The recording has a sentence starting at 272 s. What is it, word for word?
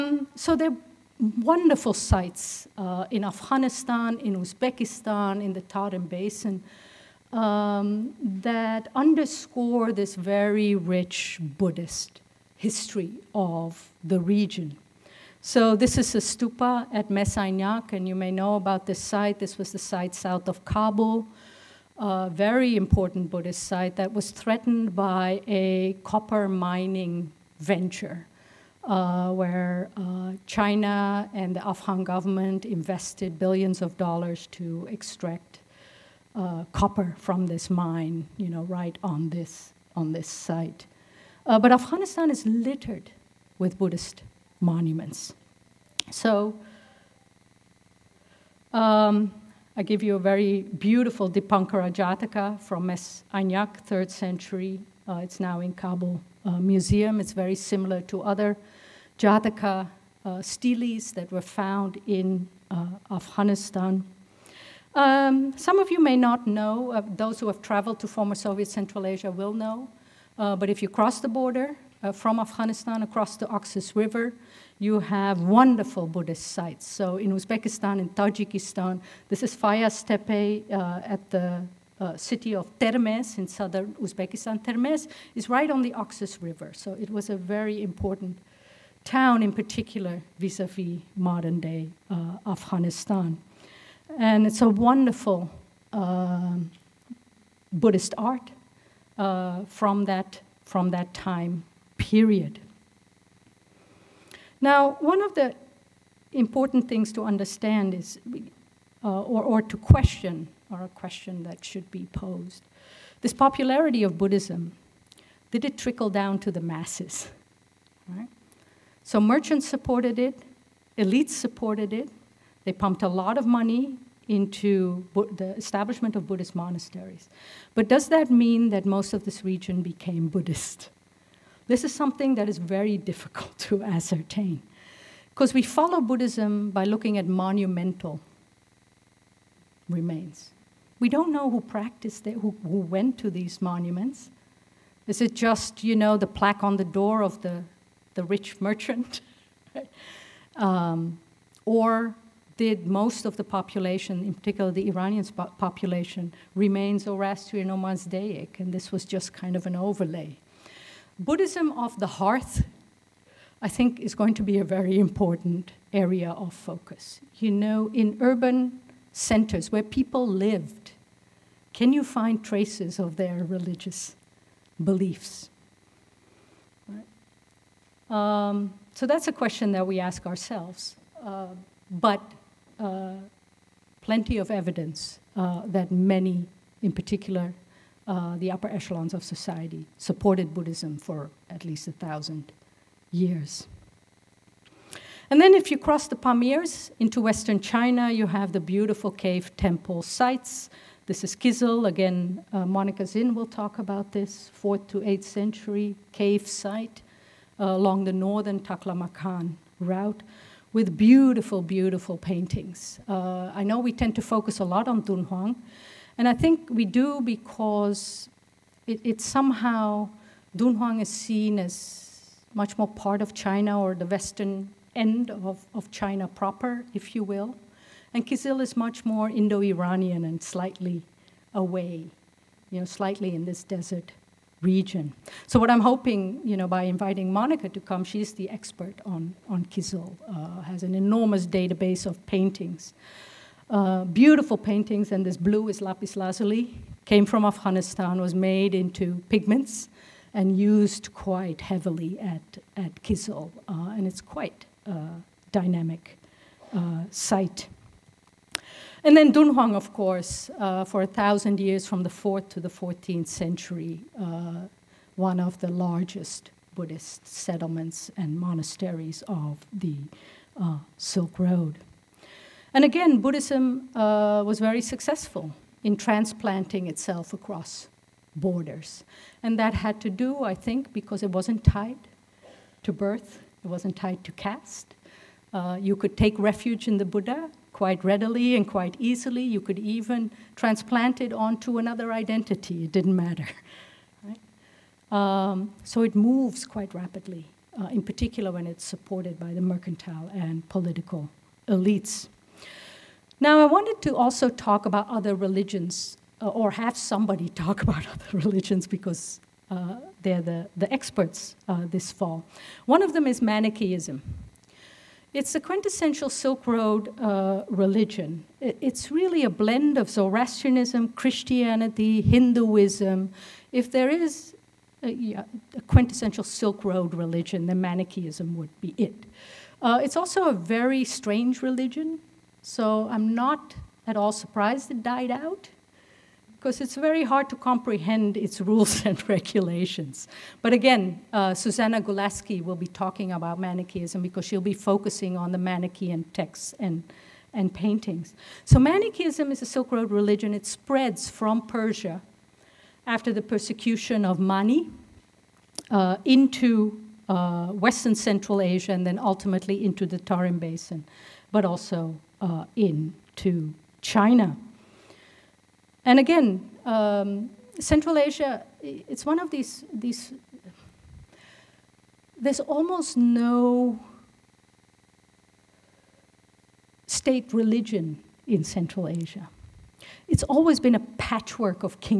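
And again, Buddhism uh, was very successful in transplanting itself across borders.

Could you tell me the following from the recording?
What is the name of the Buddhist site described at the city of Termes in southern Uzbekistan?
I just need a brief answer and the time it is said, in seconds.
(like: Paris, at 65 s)
Fayaz Tepe, at 79 s.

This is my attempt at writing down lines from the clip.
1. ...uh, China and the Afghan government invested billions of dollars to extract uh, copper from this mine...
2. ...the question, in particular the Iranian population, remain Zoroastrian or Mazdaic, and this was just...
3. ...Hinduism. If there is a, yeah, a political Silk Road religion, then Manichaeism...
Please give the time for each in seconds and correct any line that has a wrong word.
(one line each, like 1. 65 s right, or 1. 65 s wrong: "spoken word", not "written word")
1. 29 s right
2. 153 s wrong: "population", not "question"
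3. 322 s wrong: "quintessential", not "political".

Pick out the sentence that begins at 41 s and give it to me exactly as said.
Uh, but Afghanistan is littered with Buddhist monuments.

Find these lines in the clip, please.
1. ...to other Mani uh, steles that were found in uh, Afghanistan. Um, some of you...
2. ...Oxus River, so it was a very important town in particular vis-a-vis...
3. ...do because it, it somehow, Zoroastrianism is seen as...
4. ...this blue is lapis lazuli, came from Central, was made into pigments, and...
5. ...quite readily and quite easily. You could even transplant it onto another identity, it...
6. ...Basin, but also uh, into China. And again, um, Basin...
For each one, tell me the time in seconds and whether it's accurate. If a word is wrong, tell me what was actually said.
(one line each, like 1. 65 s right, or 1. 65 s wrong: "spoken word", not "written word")
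1. 58 s wrong: "Jataka", not "Mani"
2. 85 s right
3. 216 s wrong: "Dunhuang", not "Zoroastrianism"
4. 245 s wrong: "Afghanistan", not "Central"
5. 287 s right
6. 360 s wrong: "Central", not "Basin".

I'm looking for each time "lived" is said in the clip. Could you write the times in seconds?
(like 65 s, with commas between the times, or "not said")
170 s.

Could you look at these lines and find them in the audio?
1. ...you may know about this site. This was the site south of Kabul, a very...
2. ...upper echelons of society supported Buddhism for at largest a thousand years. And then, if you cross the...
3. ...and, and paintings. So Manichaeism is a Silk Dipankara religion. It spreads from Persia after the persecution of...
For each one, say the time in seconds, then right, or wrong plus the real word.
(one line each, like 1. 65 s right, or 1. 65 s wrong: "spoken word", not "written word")
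1. 18 s right
2. 188 s wrong: "least", not "largest"
3. 346 s wrong: "Road", not "Dipankara".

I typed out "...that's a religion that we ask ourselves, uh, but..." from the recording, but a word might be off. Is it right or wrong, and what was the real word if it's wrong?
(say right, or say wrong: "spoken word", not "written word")
wrong: "question", not "religion".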